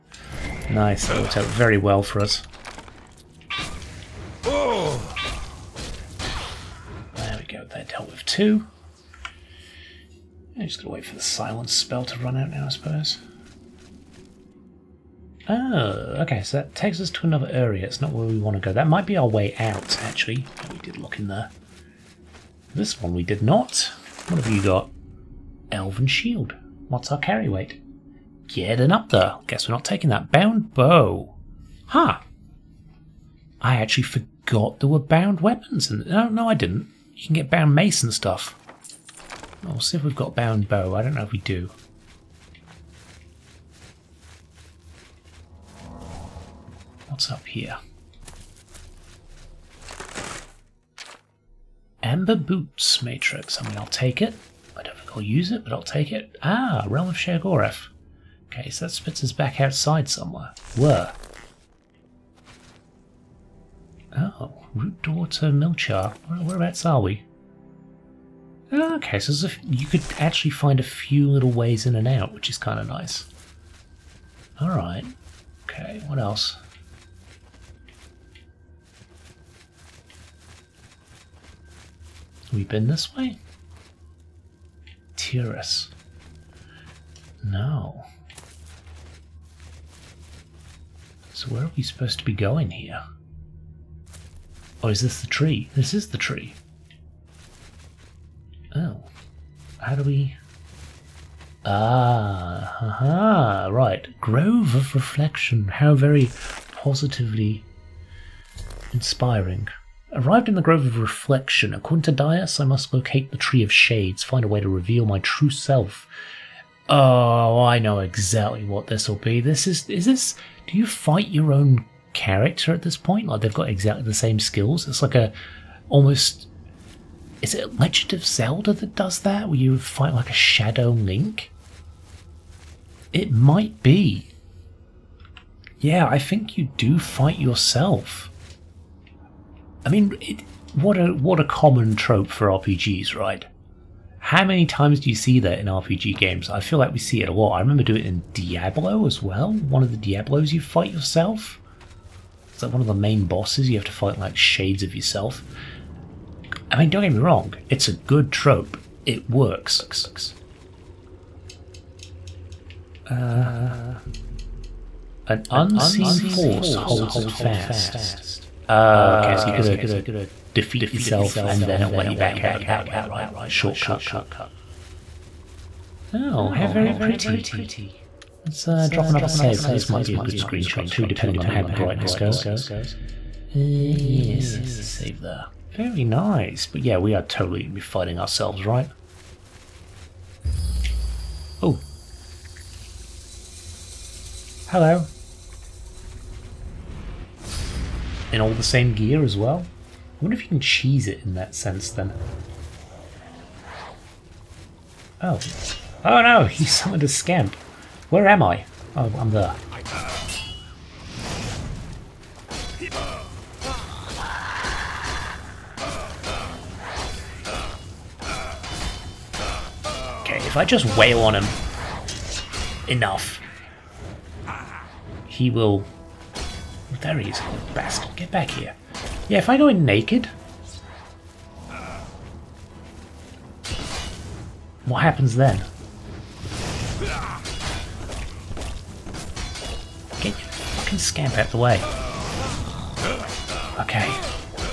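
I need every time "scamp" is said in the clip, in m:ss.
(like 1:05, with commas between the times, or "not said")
3:27, 4:00.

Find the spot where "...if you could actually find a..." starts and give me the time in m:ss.
1:09.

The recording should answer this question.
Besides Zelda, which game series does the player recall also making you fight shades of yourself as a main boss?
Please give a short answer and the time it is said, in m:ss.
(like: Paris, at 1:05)
Diablo, at 2:28.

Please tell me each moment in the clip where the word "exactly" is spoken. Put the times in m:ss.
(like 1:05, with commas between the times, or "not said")
1:57, 2:03.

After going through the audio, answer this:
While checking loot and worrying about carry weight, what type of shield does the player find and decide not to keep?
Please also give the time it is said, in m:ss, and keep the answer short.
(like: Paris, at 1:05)
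Elven Shield, at 0:25.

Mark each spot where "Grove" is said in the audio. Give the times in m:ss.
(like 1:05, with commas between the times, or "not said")
1:44, 1:50.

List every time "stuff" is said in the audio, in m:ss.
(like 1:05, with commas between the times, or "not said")
0:38.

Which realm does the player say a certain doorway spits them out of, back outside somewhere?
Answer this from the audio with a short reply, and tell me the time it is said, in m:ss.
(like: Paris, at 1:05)
Realm of Sheogorath, at 0:56.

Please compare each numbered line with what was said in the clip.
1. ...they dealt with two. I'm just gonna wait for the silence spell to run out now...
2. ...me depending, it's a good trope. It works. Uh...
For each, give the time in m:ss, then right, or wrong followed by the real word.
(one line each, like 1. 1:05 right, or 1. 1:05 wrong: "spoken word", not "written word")
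1. 0:07 right
2. 2:37 wrong: "wrong", not "depending".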